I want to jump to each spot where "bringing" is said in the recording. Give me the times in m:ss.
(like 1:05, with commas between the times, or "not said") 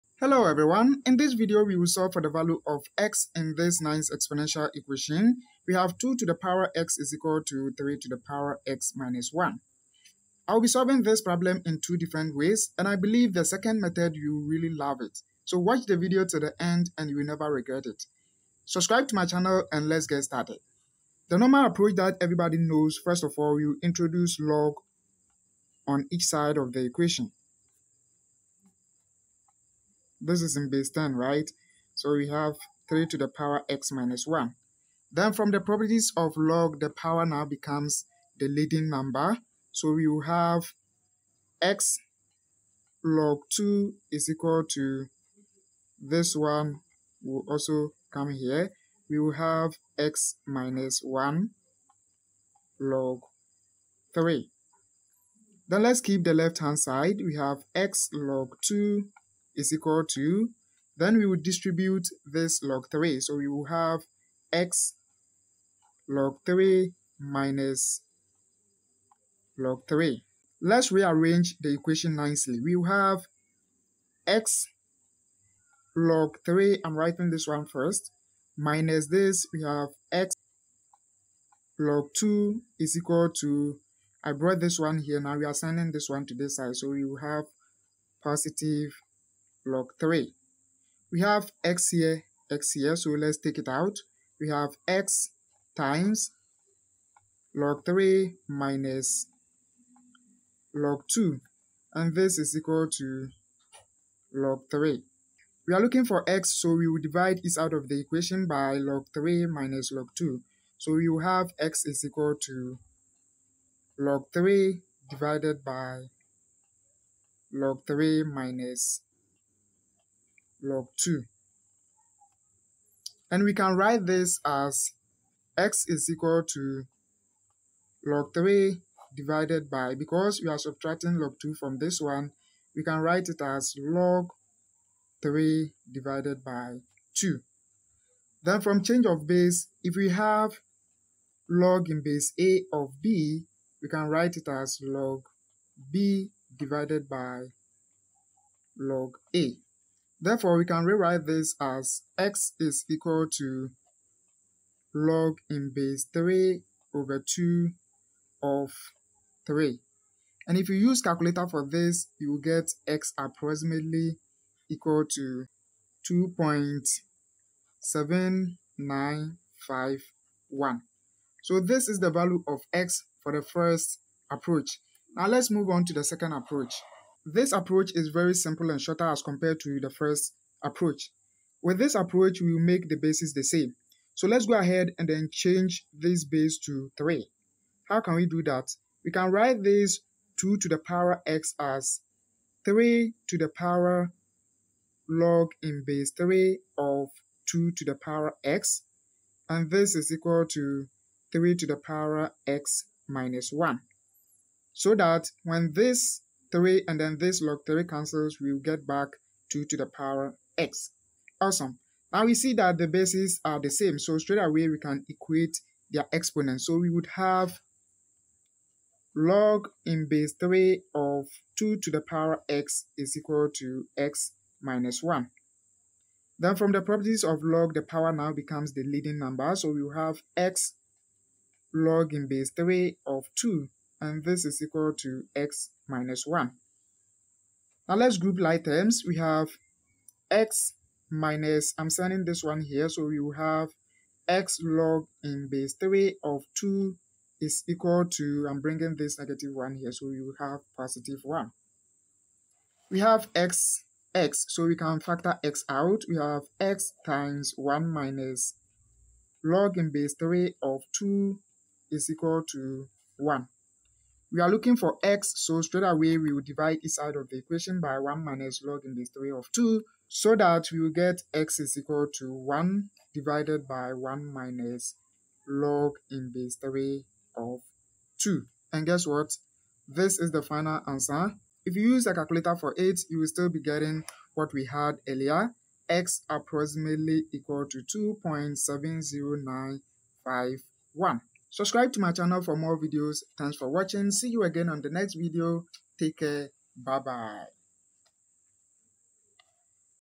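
4:08.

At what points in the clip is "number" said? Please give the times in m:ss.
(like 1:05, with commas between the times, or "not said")
0:38, 3:49.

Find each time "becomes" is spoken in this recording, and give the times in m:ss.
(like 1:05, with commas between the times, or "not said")
0:37, 3:48.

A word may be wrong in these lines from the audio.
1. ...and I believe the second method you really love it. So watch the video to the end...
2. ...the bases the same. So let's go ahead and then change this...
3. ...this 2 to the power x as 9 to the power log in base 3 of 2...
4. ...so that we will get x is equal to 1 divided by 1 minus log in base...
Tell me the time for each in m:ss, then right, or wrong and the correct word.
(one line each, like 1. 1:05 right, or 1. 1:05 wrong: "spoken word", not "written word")
1. 0:12 right
2. 3:02 right
3. 3:09 wrong: "3", not "9"
4. 4:30 right.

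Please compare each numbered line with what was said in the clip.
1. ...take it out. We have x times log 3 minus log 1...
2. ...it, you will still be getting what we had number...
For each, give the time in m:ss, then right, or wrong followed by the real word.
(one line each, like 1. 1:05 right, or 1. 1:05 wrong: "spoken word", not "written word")
1. 1:33 wrong: "2", not "1"
2. 4:42 wrong: "earlier", not "number".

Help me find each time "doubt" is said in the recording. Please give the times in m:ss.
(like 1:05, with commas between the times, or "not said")
not said.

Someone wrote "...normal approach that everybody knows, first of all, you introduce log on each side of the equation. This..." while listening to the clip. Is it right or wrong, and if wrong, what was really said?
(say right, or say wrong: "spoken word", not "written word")
right.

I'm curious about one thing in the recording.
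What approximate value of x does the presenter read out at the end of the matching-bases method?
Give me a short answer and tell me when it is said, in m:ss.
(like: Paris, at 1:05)
2.70951, at 4:48.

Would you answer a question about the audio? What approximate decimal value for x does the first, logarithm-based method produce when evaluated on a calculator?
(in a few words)
2.7951.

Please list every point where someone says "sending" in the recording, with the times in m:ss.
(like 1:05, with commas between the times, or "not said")
1:25, 4:01.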